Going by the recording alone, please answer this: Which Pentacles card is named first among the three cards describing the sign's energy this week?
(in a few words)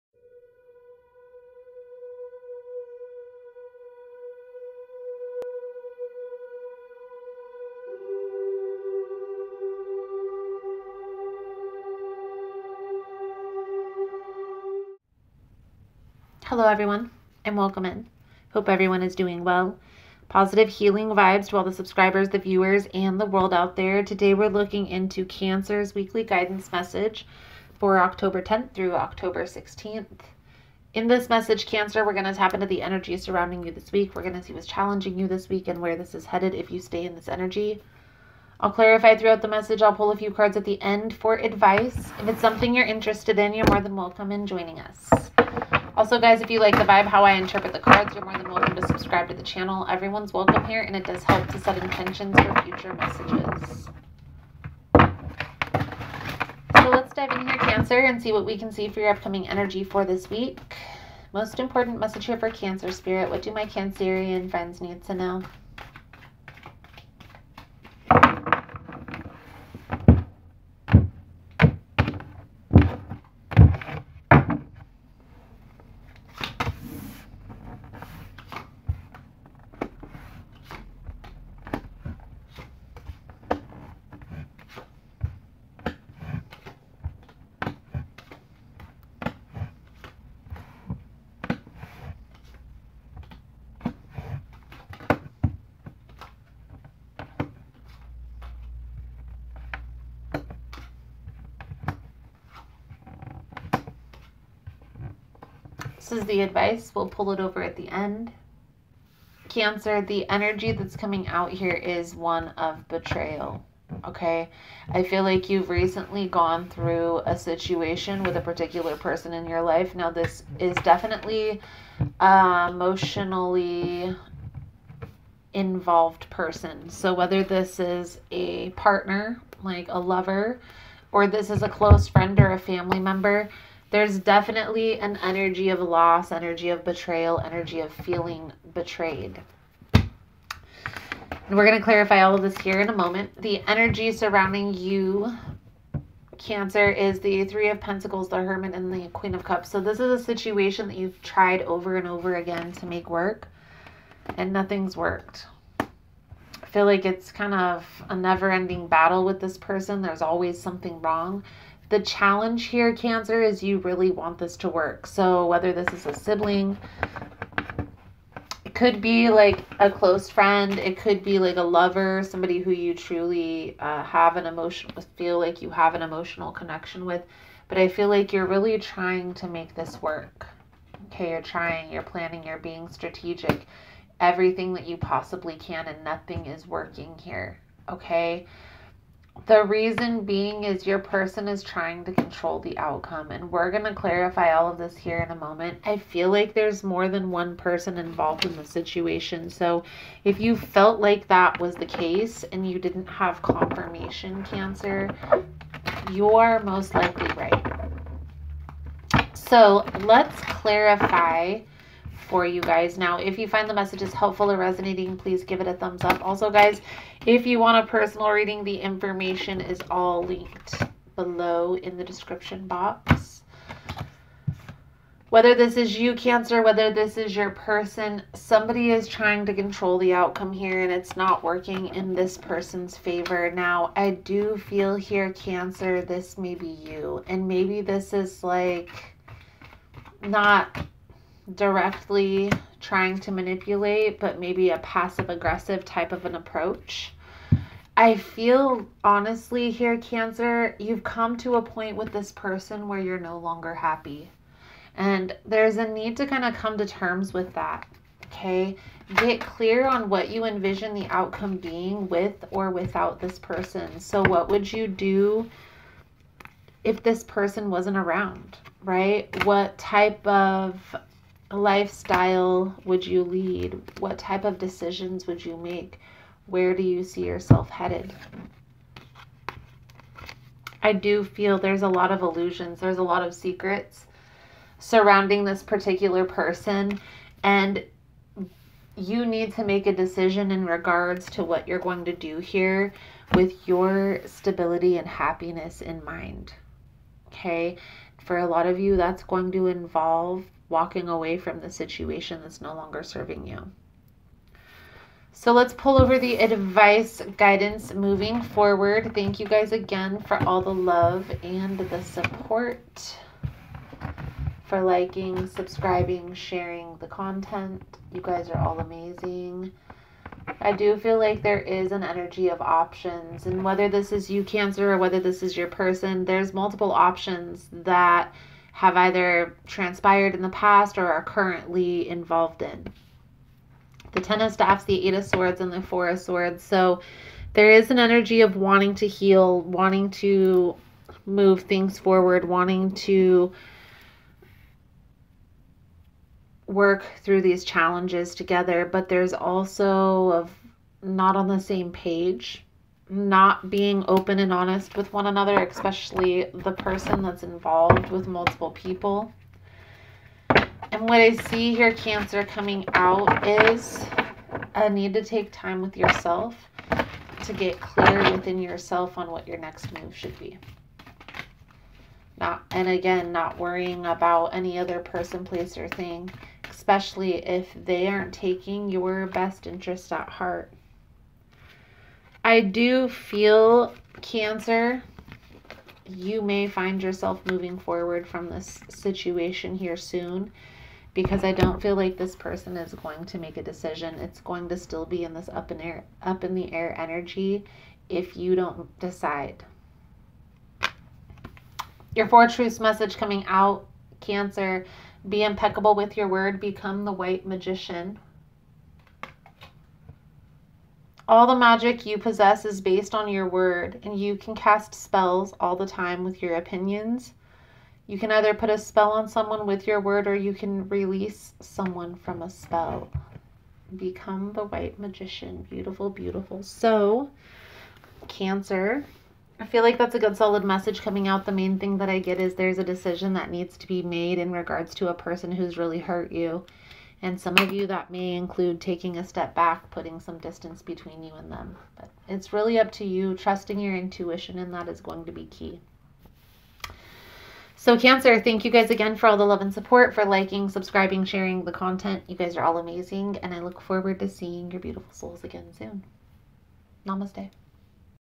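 Three of Pentacles.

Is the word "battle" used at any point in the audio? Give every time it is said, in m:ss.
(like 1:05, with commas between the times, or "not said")
2:38.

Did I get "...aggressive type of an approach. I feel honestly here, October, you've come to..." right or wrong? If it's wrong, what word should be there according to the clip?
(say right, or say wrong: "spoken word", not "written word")
wrong: "Cancer", not "October".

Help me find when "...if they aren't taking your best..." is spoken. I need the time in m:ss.
6:17.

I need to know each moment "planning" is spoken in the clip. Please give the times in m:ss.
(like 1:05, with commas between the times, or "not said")
3:02.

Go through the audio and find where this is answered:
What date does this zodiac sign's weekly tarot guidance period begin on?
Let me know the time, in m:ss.
0:28.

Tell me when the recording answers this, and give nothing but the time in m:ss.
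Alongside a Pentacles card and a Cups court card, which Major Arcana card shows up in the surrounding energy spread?
2:28.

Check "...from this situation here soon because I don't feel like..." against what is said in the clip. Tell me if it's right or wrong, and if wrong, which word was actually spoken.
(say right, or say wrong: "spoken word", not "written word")
right.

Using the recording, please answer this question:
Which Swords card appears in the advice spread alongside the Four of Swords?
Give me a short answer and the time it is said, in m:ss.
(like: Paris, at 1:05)
Eight of Swords, at 5:35.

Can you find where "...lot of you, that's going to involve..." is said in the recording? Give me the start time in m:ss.
4:58.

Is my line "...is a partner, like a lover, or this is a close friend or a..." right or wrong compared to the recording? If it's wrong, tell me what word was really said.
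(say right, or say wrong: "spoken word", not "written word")
right.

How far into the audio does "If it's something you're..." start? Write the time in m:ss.
0:42.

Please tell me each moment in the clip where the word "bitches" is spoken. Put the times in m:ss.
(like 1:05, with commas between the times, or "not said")
not said.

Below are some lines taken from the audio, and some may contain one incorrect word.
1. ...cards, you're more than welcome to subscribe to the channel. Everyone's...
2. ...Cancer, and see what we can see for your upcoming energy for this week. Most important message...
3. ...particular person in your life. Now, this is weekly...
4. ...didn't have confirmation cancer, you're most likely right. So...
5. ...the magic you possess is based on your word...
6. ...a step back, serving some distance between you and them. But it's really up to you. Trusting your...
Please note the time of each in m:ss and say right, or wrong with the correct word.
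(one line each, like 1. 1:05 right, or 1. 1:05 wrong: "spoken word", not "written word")
1. 0:47 right
2. 0:57 right
3. 1:58 wrong: "definitely", not "weekly"
4. 3:22 right
5. 6:51 right
6. 7:19 wrong: "putting", not "serving".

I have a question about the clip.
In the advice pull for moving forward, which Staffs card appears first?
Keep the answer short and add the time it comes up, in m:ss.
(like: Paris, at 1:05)
Ten of Staffs, at 5:34.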